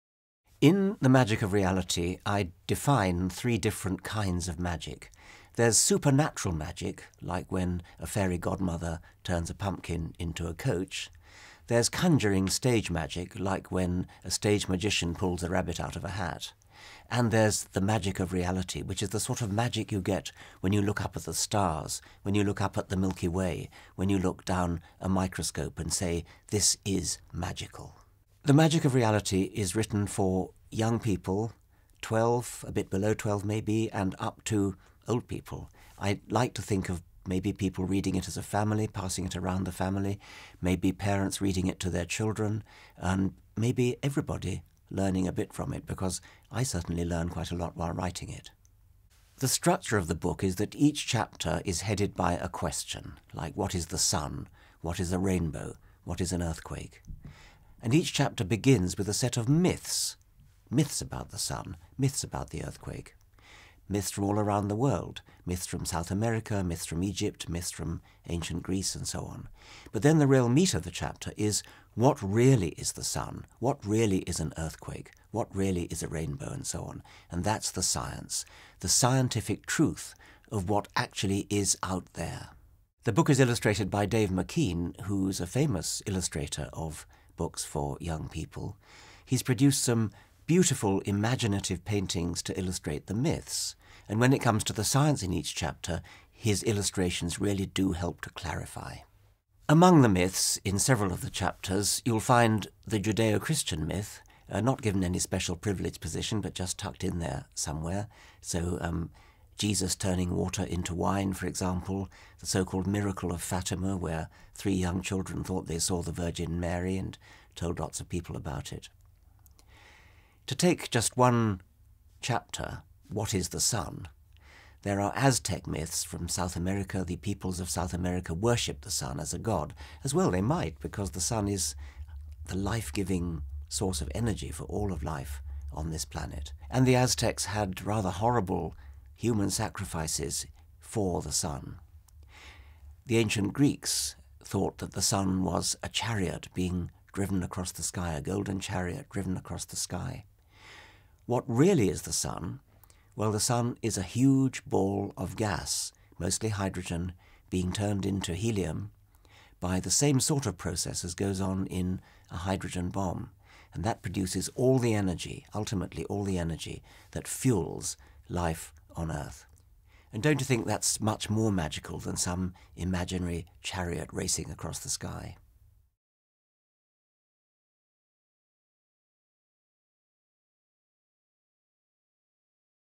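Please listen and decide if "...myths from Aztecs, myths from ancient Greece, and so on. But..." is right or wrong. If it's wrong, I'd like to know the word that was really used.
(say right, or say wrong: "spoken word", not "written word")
wrong: "Egypt", not "Aztecs".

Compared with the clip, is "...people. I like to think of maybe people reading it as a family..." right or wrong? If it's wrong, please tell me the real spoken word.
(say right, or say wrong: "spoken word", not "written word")
right.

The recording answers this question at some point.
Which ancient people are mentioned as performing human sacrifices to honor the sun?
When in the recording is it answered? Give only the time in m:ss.
2:16.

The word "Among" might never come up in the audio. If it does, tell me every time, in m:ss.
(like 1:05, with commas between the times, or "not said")
1:39.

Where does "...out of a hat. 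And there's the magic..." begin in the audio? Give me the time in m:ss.
0:15.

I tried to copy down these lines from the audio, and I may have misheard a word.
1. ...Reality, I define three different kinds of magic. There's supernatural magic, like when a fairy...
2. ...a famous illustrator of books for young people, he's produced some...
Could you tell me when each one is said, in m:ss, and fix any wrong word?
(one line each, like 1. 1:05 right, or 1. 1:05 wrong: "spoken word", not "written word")
1. 0:01 right
2. 1:25 right.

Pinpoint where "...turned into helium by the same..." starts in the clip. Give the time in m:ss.
2:37.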